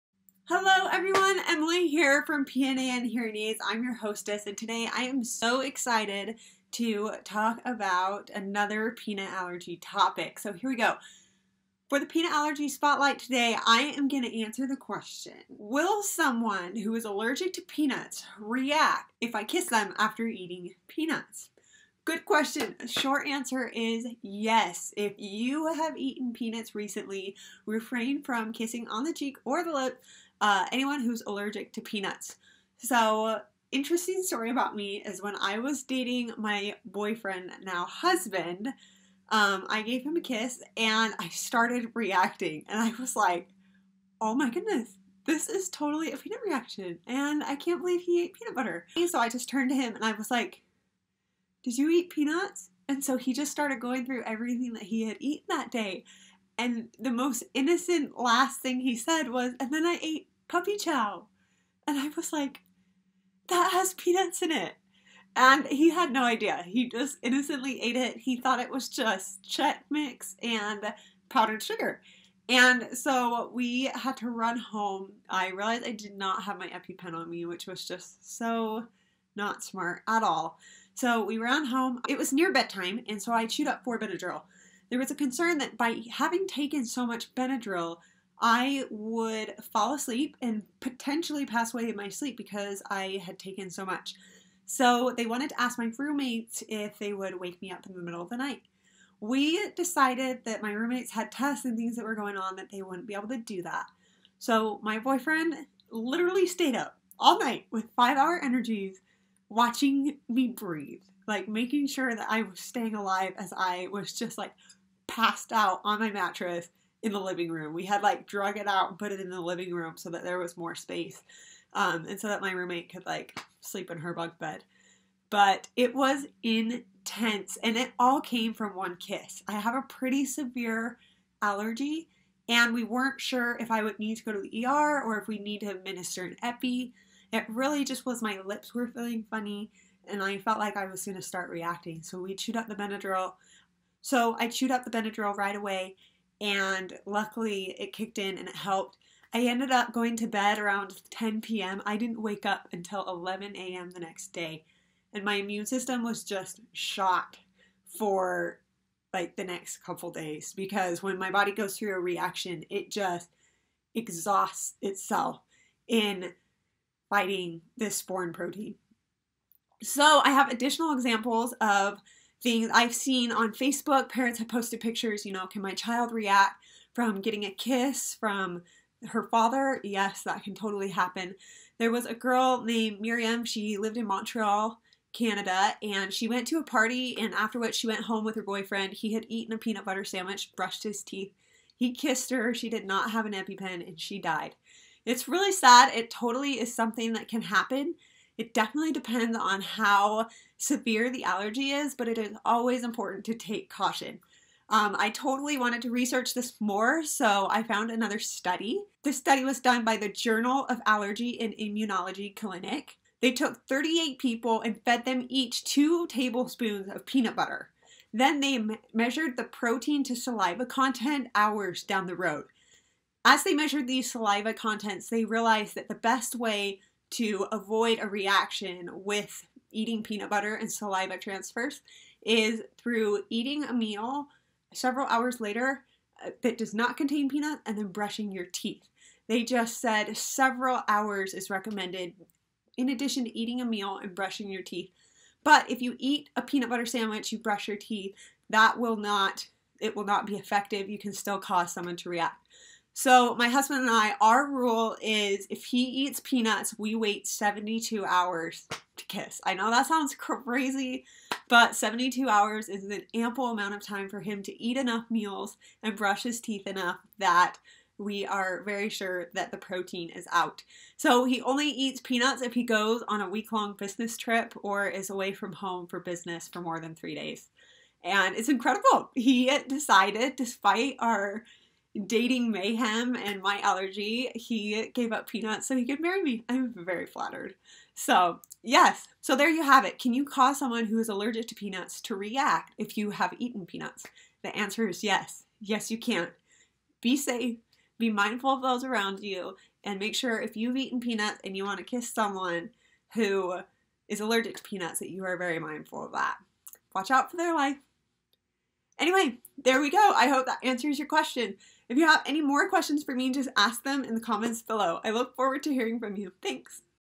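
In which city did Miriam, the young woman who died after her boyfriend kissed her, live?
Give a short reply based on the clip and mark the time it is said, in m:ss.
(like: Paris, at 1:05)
Montreal, at 3:04.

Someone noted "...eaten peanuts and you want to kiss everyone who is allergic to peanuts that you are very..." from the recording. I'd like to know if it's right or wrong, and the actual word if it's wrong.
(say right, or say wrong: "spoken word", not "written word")
wrong: "someone", not "everyone".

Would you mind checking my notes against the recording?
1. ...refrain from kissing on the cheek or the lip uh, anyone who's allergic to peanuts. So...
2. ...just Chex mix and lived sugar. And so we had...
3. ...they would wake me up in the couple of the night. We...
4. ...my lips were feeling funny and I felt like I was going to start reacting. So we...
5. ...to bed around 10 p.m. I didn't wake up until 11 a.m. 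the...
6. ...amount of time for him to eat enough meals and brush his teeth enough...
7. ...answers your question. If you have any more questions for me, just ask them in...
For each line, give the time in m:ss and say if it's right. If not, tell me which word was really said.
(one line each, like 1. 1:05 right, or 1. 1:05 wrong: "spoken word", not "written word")
1. 0:27 right
2. 1:08 wrong: "powdered", not "lived"
3. 1:36 wrong: "middle", not "couple"
4. 2:18 right
5. 2:30 right
6. 4:23 right
7. 5:10 right.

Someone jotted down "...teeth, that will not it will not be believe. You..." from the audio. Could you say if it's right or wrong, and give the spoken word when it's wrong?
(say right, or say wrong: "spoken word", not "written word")
wrong: "effective", not "believe".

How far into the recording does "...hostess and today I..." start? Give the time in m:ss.
0:03.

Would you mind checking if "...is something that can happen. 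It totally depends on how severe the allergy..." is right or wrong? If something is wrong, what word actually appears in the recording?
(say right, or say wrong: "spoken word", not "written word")
wrong: "definitely", not "totally".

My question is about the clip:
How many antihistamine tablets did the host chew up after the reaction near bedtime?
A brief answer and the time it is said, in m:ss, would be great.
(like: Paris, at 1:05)
4, at 1:23.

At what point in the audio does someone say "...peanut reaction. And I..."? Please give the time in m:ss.
0:46.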